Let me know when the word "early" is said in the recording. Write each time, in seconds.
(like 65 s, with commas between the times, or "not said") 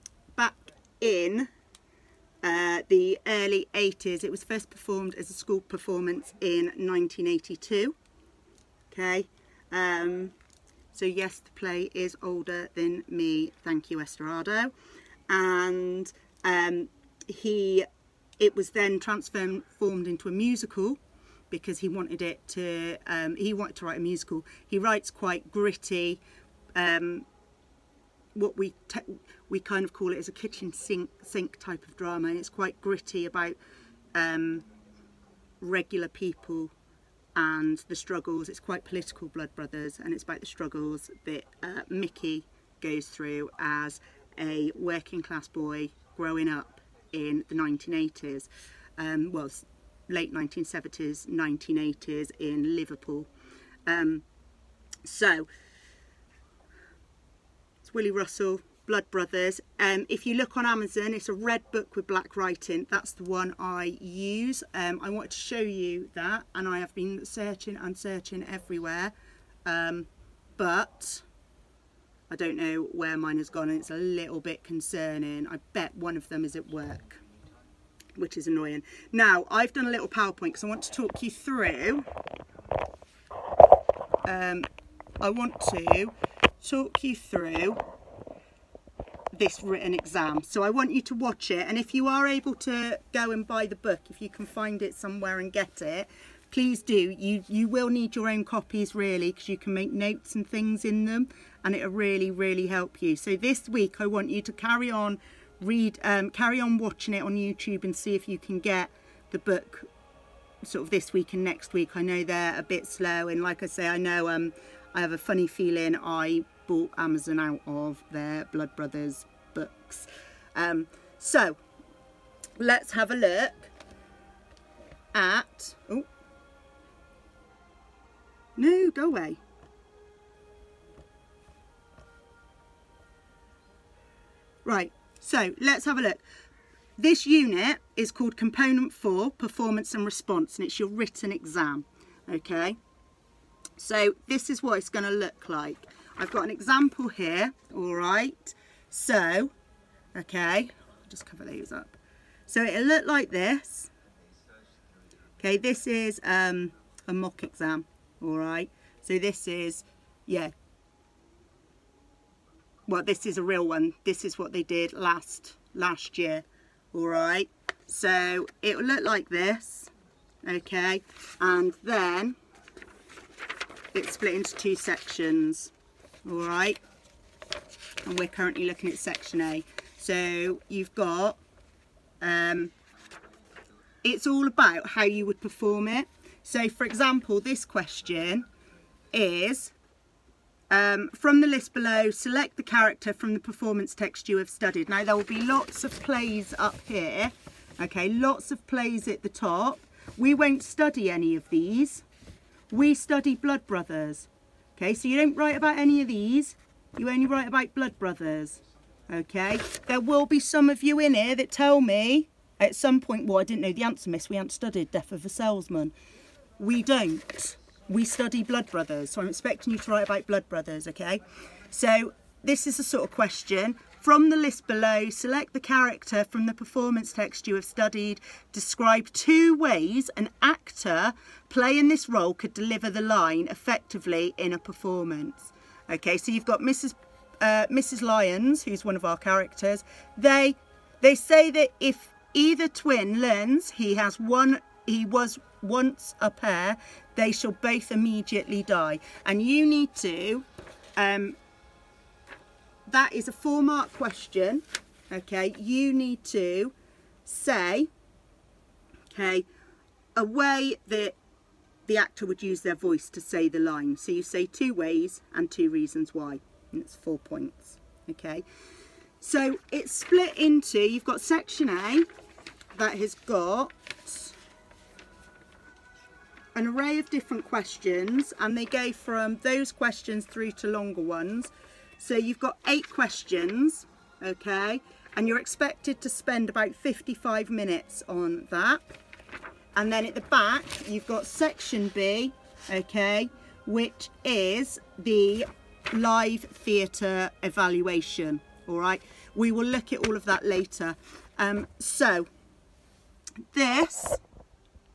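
3 s.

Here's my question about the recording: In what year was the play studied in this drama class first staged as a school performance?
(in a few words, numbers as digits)
1982.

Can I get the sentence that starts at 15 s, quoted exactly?
And um, he, it was then transformed into a musical because he wanted it to, um, he wanted to write a musical.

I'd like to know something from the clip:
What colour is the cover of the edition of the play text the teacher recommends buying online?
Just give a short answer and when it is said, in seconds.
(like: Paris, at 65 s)
Red, at 61 s.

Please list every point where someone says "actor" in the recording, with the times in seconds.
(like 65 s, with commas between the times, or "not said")
230 s, 261 s.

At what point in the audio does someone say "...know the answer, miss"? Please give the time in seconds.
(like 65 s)
213 s.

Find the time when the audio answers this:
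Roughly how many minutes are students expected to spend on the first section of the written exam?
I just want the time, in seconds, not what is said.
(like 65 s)
286 s.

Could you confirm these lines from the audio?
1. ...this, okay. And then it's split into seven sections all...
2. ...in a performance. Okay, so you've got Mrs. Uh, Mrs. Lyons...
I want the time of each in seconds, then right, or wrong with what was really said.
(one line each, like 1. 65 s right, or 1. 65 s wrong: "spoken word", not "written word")
1. 169 s wrong: "two", not "seven"
2. 234 s right.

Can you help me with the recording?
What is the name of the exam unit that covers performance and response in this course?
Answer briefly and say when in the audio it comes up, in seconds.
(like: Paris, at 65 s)
Component 4, at 138 s.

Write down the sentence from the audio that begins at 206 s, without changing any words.
You only write about blood brothers.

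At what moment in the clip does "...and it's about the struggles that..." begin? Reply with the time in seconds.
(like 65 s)
40 s.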